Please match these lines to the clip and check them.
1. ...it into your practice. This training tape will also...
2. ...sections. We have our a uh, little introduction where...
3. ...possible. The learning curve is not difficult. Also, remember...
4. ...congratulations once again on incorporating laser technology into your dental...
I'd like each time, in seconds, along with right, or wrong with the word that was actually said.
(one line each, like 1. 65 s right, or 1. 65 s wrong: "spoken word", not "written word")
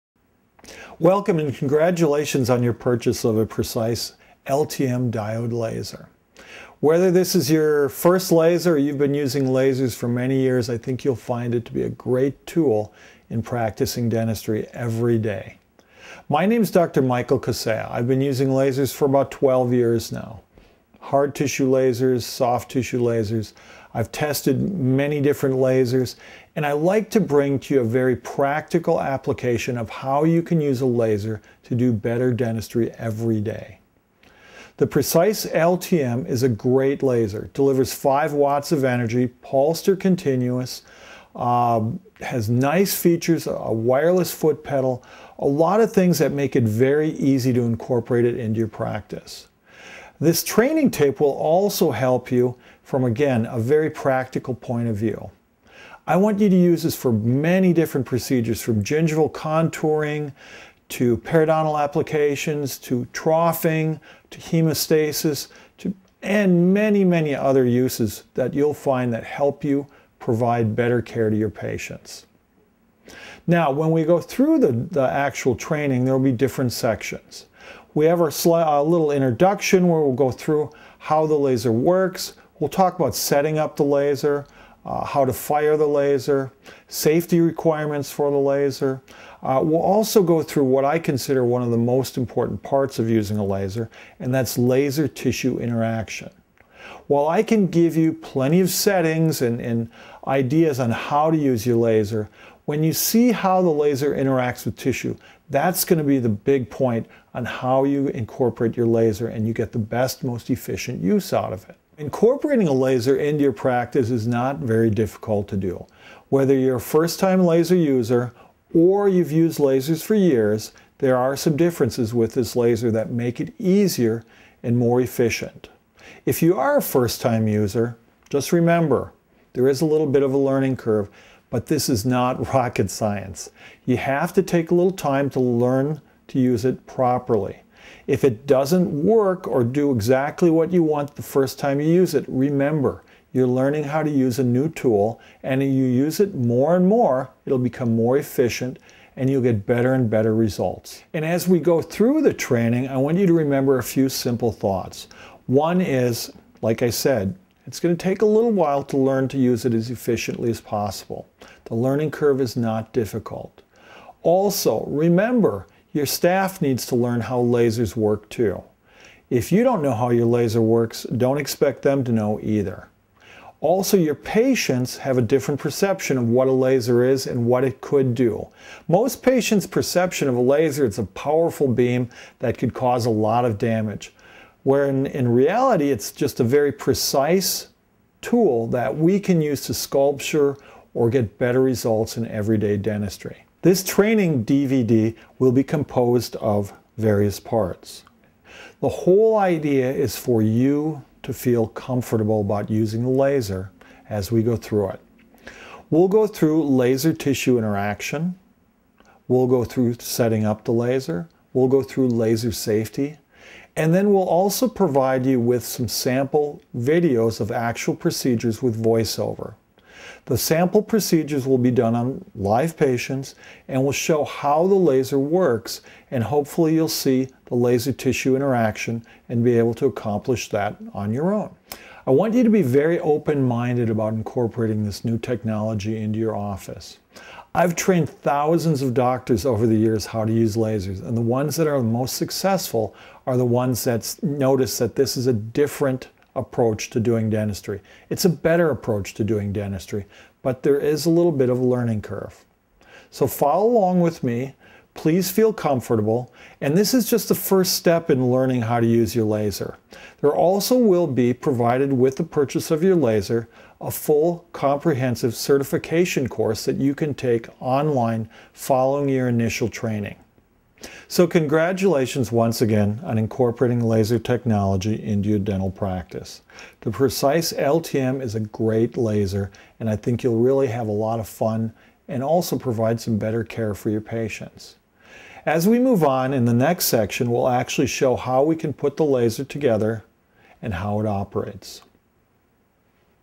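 1. 48 s right
2. 76 s right
3. 160 s right
4. 271 s right.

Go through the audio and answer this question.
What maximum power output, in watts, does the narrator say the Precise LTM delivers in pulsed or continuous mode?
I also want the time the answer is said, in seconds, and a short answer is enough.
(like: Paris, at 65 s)
5 watts, at 37 s.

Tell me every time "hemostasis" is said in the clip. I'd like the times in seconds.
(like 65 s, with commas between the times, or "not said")
64 s.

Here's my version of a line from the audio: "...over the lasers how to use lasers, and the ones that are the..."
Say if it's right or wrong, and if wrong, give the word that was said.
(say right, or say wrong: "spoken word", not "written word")
wrong: "years", not "lasers".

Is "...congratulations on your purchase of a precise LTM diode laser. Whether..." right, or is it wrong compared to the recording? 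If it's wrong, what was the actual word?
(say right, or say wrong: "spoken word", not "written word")
right.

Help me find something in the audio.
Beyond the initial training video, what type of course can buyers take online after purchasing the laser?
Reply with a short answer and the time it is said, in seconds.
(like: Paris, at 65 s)
Comprehensive certification course, at 264 s.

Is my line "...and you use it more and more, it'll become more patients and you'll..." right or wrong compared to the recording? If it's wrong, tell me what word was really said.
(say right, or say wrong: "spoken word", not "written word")
wrong: "efficient", not "patients".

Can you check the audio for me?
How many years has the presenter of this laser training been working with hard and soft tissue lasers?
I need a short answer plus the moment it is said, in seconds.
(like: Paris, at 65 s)
12, at 19 s.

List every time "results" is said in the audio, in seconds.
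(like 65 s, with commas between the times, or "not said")
150 s, 191 s.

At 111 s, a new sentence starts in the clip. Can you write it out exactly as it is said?
Incorporating a laser into your practice is not very difficult to do.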